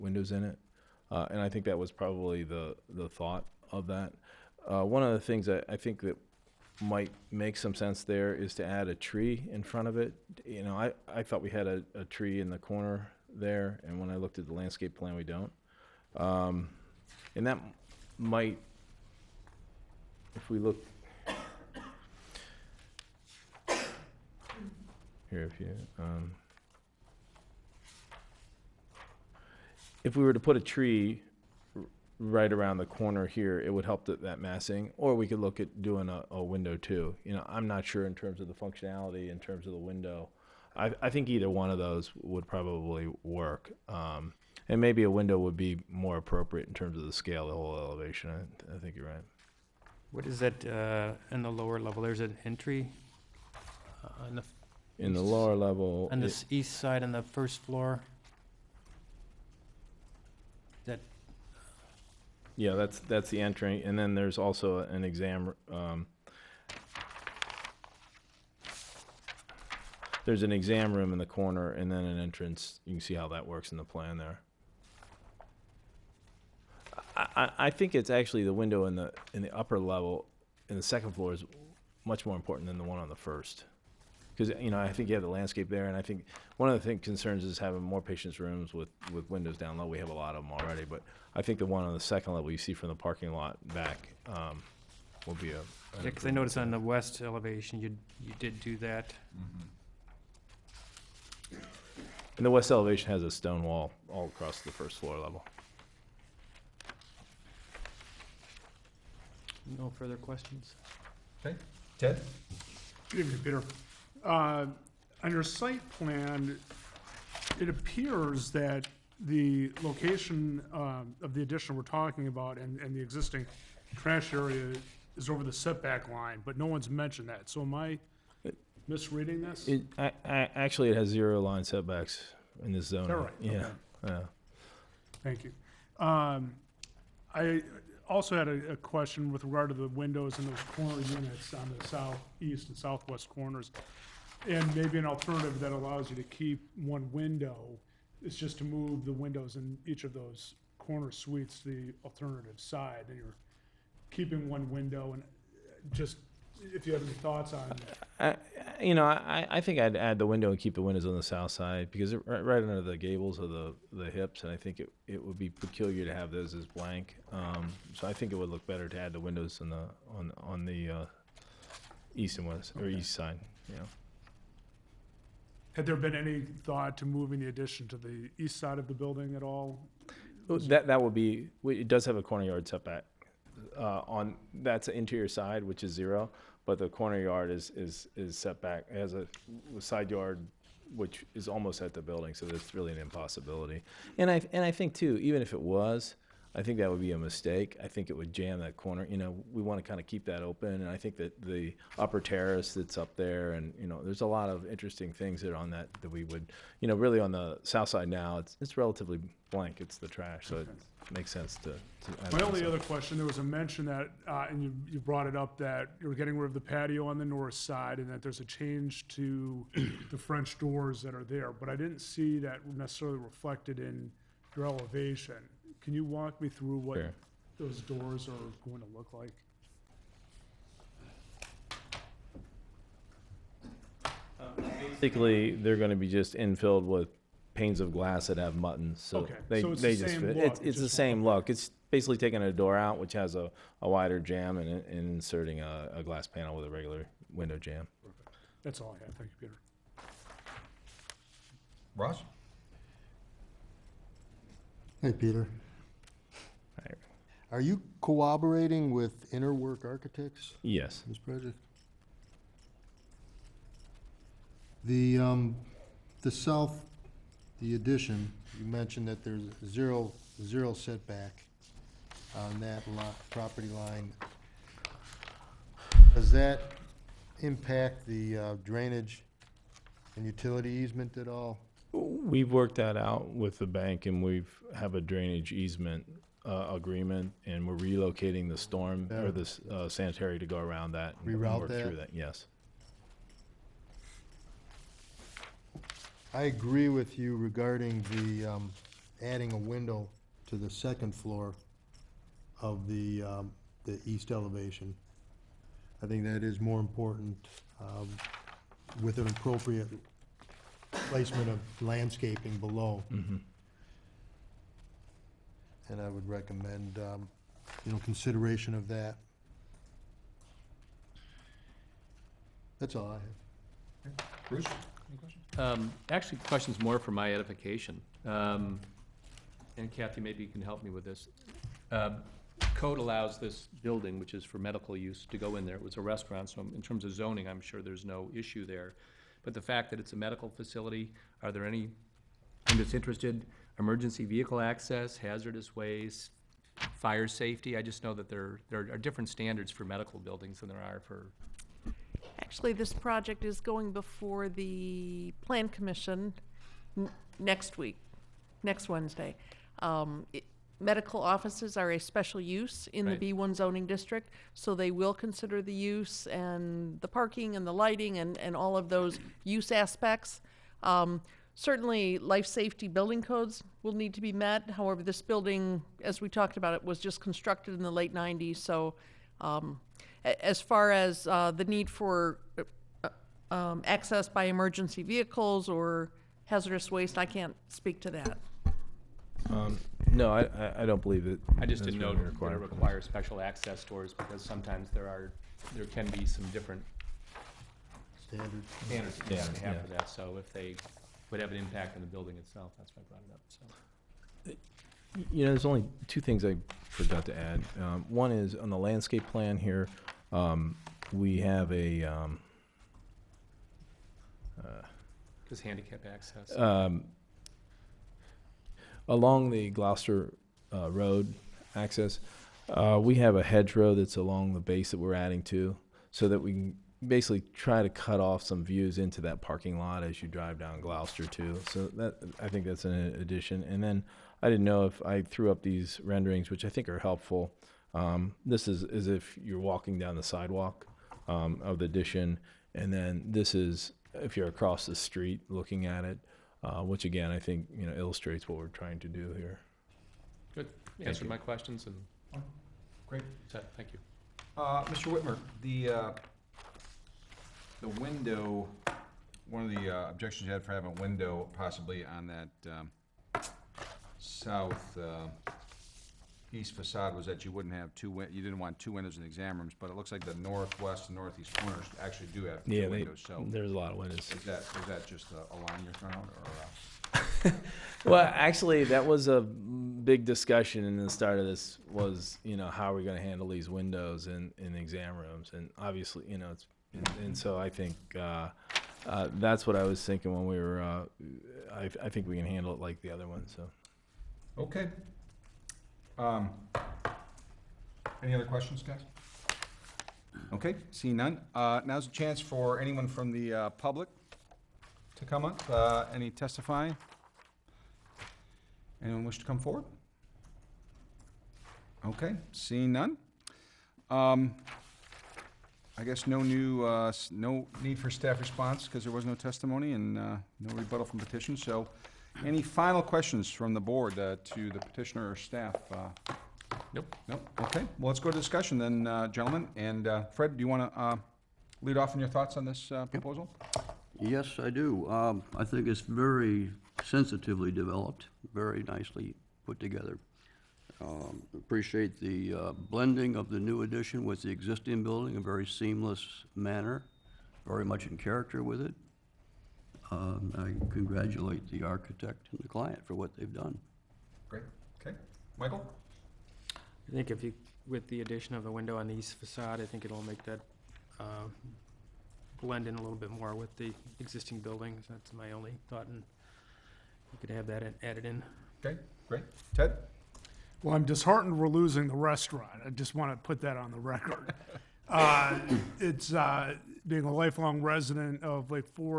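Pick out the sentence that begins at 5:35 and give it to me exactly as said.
It was a restaurant, so in terms of zoning, I'm sure there's no issue there.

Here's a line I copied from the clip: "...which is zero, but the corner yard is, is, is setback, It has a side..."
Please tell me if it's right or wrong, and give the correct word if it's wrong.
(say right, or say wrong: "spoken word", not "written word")
right.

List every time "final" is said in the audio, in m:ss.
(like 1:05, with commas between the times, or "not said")
8:42.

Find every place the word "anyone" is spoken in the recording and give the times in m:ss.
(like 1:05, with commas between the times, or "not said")
8:22, 8:29.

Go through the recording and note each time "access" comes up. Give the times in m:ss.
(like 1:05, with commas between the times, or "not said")
5:44, 6:23, 6:33, 6:56, 7:01.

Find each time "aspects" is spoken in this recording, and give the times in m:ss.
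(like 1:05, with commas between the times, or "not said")
6:09.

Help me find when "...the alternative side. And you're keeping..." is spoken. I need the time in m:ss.
2:31.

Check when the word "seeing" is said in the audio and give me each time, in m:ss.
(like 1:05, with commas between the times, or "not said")
8:20, 8:32.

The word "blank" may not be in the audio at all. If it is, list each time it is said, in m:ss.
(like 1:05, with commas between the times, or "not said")
2:46, 3:29.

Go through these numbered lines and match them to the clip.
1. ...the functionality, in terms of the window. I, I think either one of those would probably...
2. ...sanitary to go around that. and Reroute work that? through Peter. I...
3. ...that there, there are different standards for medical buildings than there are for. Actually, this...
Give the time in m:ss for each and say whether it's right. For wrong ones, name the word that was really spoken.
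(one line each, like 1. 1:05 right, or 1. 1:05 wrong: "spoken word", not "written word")
1. 0:38 right
2. 4:49 wrong: "Yes", not "Peter"
3. 5:48 right.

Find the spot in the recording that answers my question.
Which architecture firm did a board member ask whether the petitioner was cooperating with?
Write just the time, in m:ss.
4:19.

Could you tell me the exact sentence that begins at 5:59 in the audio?
Um, it- medical offices are a special use in Right.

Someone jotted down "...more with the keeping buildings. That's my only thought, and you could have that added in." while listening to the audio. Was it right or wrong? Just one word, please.
wrong.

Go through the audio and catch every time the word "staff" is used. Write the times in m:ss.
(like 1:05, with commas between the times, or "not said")
8:38, 8:45.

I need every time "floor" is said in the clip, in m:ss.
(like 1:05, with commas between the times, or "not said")
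0:57, 1:21, 1:44, 5:01.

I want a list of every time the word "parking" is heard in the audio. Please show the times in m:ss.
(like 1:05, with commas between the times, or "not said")
1:32, 6:07, 7:09.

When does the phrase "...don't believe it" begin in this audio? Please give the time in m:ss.
6:30.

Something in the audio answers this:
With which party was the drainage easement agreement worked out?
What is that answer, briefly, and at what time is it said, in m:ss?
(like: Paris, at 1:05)
The bank, at 4:43.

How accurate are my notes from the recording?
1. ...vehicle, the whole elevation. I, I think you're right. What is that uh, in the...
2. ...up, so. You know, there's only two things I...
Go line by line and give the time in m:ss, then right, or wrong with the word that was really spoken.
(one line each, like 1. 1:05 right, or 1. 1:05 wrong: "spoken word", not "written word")
1. 0:47 wrong: "scale", not "vehicle"
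2. 6:43 right.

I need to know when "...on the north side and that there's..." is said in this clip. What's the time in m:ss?
3:37.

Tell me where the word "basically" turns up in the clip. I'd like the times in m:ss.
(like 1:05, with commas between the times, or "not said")
3:54, 4:01, 7:07.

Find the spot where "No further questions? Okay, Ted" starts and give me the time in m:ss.
1:49.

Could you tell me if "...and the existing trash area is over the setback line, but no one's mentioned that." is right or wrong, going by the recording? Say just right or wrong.
right.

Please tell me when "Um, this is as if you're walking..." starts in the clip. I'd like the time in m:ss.
7:17.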